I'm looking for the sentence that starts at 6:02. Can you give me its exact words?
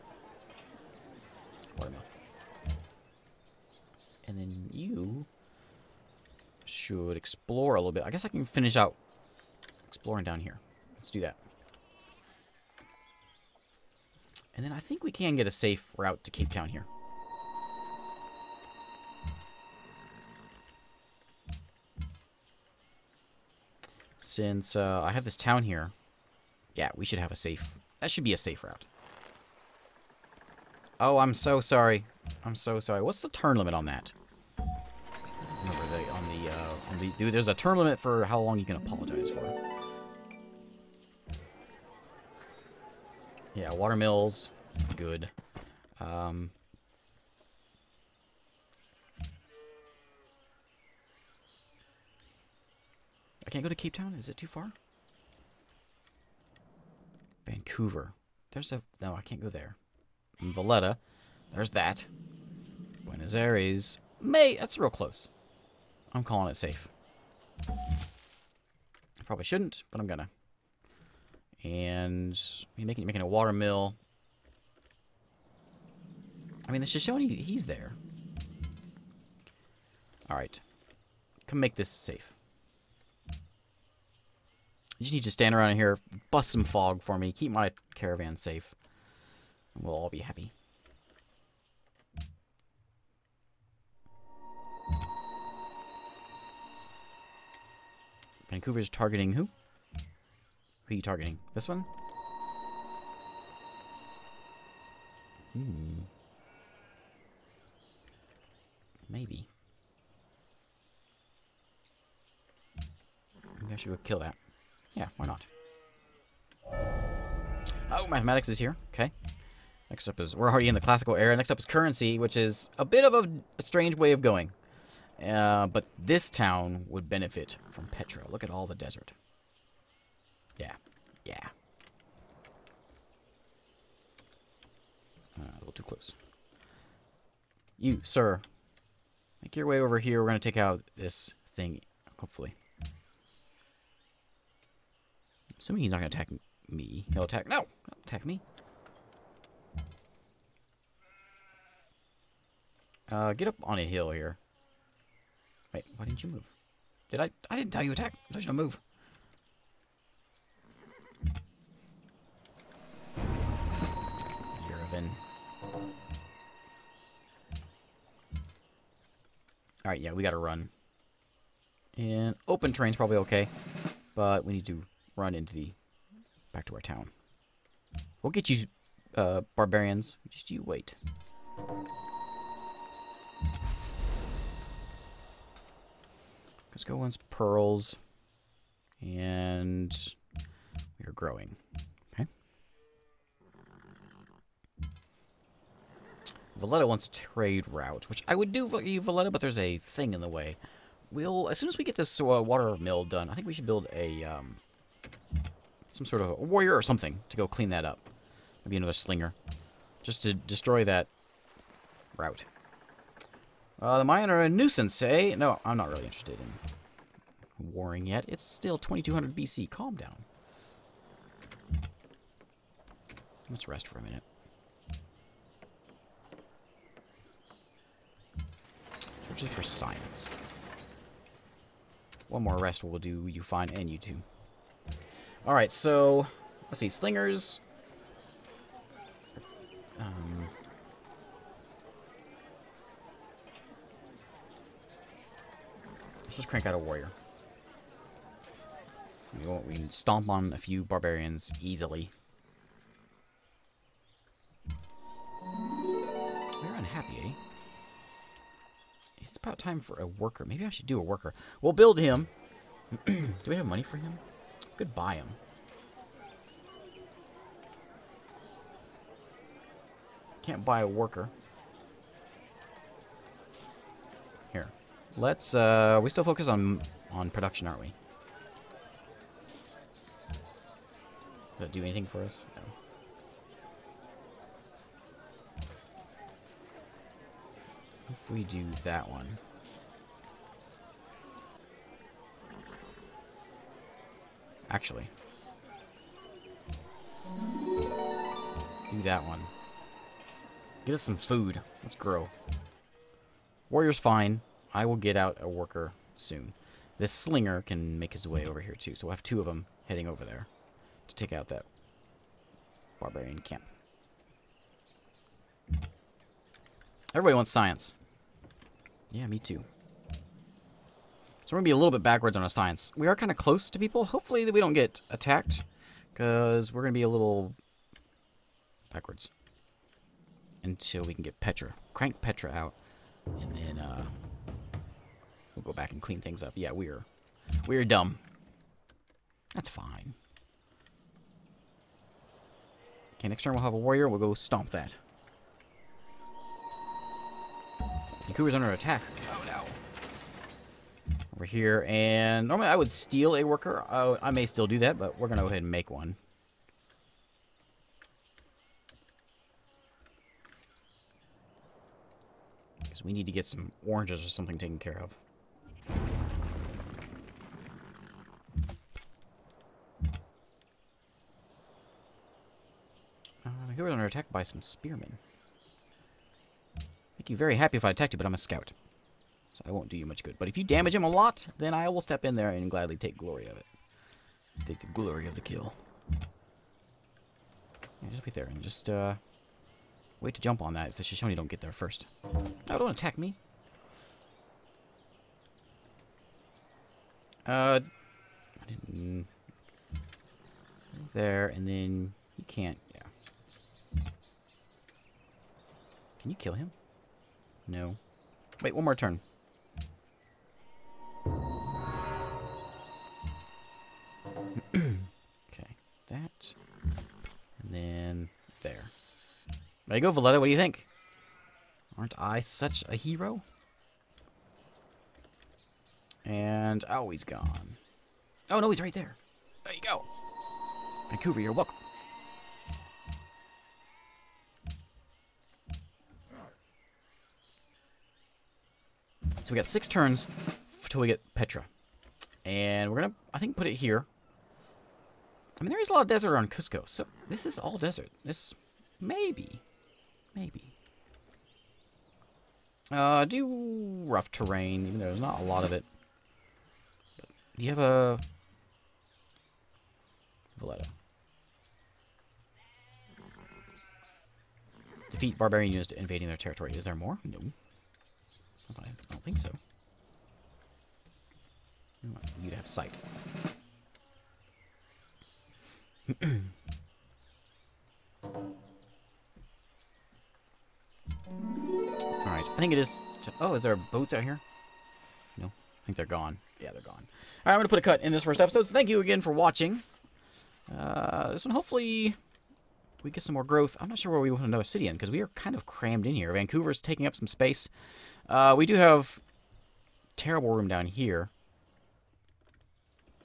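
Because we need to get some oranges or something taken care of.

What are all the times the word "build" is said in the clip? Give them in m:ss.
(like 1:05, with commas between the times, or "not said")
3:23, 4:21.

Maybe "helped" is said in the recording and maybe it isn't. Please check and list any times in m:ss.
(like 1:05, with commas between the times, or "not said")
not said.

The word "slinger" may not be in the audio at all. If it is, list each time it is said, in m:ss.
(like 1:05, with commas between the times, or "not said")
3:28, 3:56, 5:07.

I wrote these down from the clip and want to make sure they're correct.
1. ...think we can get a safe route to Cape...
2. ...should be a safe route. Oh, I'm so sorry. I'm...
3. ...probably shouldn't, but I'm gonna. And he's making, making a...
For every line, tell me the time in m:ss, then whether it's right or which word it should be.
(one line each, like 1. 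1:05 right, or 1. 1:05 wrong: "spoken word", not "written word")
1. 0:14 right
2. 0:28 right
3. 1:09 right.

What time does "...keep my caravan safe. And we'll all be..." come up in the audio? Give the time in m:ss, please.
1:27.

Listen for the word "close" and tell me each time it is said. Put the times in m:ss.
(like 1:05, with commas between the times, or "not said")
1:04, 2:15, 5:23.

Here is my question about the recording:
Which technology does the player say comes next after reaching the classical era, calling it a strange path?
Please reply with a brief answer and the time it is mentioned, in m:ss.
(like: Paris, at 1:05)
Currency, at 2:01.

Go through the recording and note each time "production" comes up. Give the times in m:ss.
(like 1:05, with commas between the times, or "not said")
4:37.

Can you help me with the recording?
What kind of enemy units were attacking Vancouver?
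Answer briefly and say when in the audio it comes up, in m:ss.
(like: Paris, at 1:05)
Spearmen, at 6:14.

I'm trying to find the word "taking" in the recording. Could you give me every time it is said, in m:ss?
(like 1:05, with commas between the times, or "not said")
8:16.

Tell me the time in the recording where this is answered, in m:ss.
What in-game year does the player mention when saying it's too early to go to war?
3:38.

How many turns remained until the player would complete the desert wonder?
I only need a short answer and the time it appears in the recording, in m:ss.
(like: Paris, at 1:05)
6, at 7:19.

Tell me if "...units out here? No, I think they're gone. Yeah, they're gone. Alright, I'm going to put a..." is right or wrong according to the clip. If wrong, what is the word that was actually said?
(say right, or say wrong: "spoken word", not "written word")
wrong: "boats", not "units".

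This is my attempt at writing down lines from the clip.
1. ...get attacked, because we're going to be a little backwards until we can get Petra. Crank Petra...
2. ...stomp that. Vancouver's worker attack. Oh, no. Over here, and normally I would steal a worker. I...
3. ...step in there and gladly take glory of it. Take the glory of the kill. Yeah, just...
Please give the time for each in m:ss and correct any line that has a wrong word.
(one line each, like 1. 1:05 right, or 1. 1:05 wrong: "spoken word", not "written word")
1. 5:24 right
2. 5:44 wrong: "under", not "worker"
3. 6:22 right.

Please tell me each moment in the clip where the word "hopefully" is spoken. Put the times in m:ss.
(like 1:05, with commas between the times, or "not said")
2:22, 5:24, 8:11.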